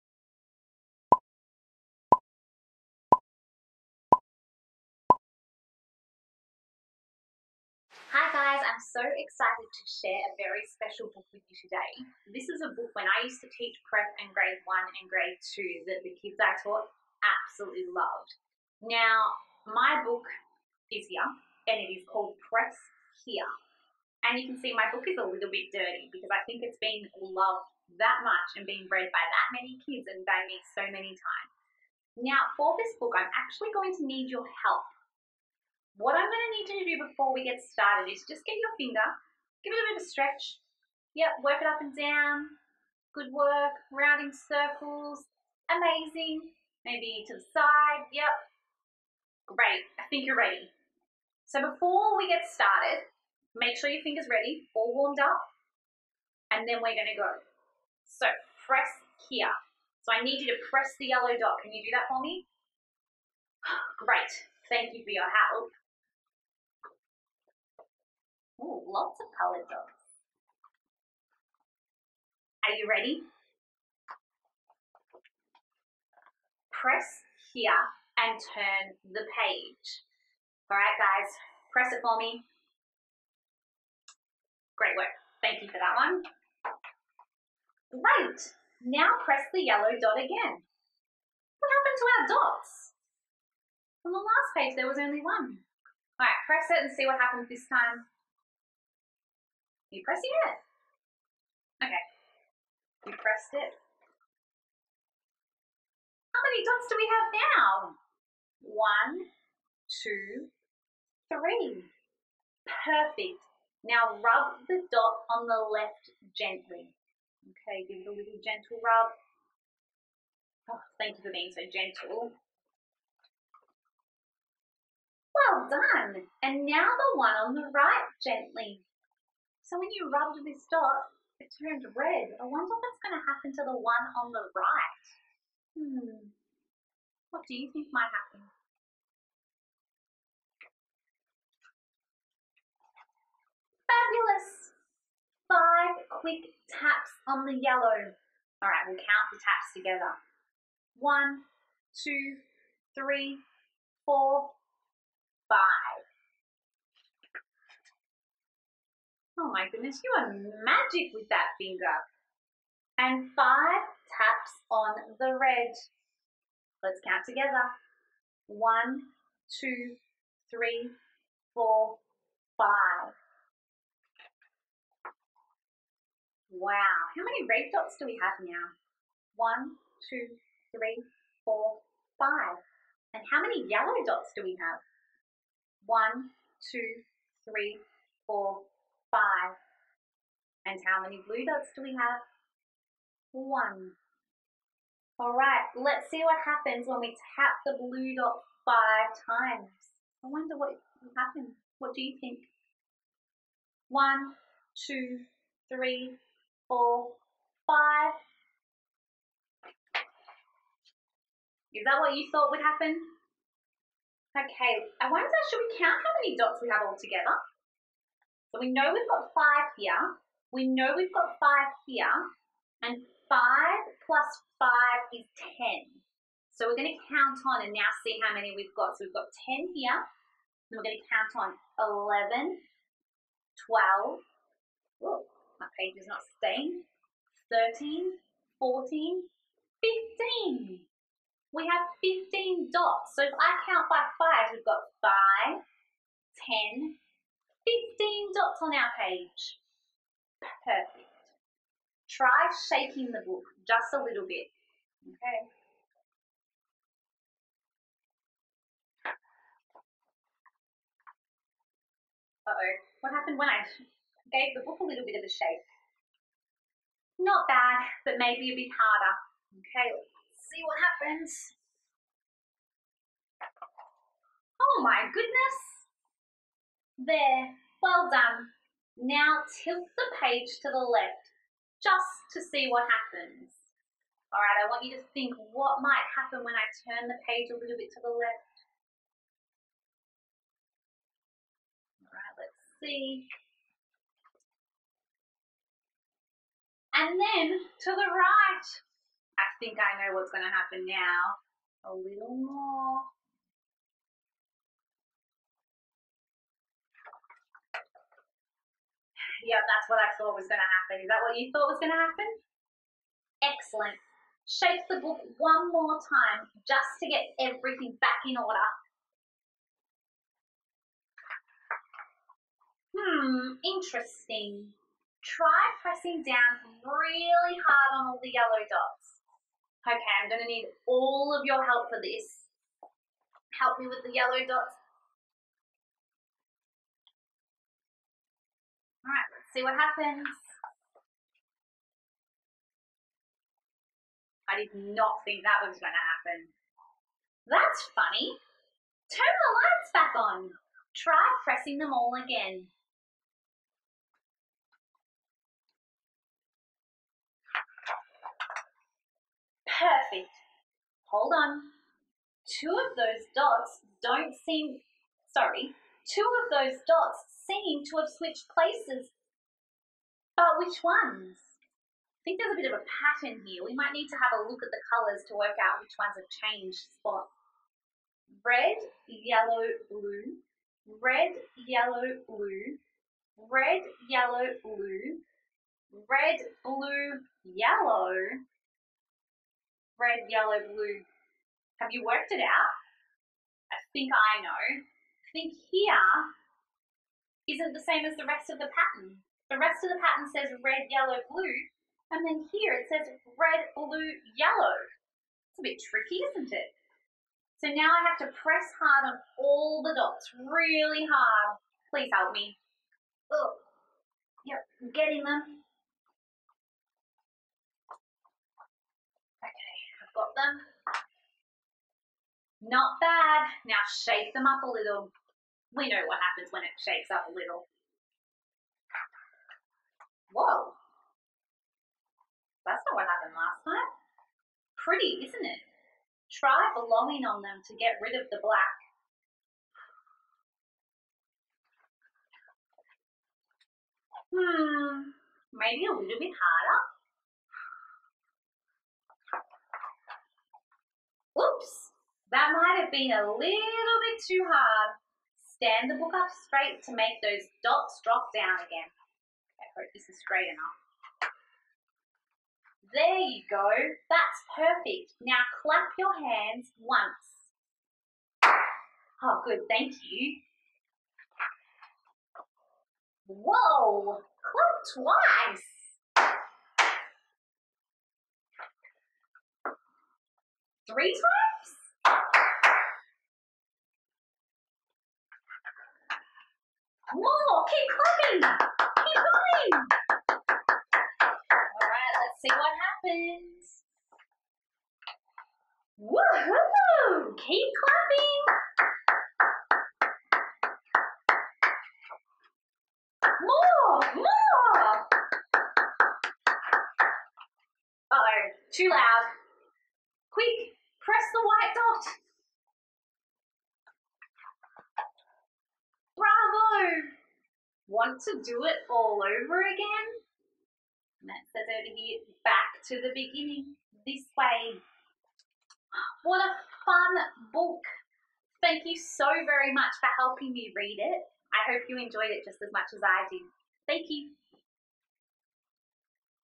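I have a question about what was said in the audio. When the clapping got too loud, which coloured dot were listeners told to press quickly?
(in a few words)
white.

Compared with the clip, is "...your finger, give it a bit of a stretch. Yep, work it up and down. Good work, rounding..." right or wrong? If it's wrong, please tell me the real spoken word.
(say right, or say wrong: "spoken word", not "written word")
right.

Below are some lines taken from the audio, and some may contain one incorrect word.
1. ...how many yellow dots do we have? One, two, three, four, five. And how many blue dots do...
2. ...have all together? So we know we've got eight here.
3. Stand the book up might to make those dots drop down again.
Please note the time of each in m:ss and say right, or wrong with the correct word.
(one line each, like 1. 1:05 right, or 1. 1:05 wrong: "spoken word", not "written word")
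1. 3:03 right
2. 3:36 wrong: "five", not "eight"
3. 7:35 wrong: "straight", not "might".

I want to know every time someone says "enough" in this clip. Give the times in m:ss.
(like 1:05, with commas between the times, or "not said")
7:40.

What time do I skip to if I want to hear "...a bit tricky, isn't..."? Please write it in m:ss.
6:45.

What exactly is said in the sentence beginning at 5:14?
Shake the book one more time just to get everything back in order.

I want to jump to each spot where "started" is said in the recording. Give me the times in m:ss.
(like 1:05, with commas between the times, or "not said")
0:37, 0:52.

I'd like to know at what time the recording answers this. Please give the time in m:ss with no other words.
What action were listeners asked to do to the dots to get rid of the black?
7:16.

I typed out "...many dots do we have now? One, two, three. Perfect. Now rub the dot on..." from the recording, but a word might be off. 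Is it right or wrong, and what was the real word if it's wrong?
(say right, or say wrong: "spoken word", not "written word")
right.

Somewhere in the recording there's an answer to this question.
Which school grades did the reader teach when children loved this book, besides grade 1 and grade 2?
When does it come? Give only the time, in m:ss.
0:13.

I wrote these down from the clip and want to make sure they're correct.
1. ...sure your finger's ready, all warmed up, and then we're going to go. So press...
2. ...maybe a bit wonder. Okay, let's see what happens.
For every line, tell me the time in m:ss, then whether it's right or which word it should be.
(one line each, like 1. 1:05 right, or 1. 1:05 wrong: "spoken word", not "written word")
1. 0:53 right
2. 4:28 wrong: "harder", not "wonder".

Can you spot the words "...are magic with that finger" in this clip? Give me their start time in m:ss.
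2:40.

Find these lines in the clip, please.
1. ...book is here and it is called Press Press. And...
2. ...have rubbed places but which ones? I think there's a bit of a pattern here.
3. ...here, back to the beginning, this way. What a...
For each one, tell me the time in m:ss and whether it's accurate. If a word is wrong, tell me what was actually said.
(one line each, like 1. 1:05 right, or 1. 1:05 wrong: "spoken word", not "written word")
1. 0:20 wrong: "Here", not "Press"
2. 6:08 wrong: "switched", not "rubbed"
3. 8:41 right.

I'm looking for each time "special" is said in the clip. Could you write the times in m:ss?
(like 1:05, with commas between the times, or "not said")
0:10.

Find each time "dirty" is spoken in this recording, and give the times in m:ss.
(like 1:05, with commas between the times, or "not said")
0:25.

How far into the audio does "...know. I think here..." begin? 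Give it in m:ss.
6:34.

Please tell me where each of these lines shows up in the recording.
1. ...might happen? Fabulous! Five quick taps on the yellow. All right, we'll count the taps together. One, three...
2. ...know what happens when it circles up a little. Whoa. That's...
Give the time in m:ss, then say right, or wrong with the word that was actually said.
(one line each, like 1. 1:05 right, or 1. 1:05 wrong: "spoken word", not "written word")
1. 2:17 wrong: "two", not "three"
2. 7:05 wrong: "shakes", not "circles".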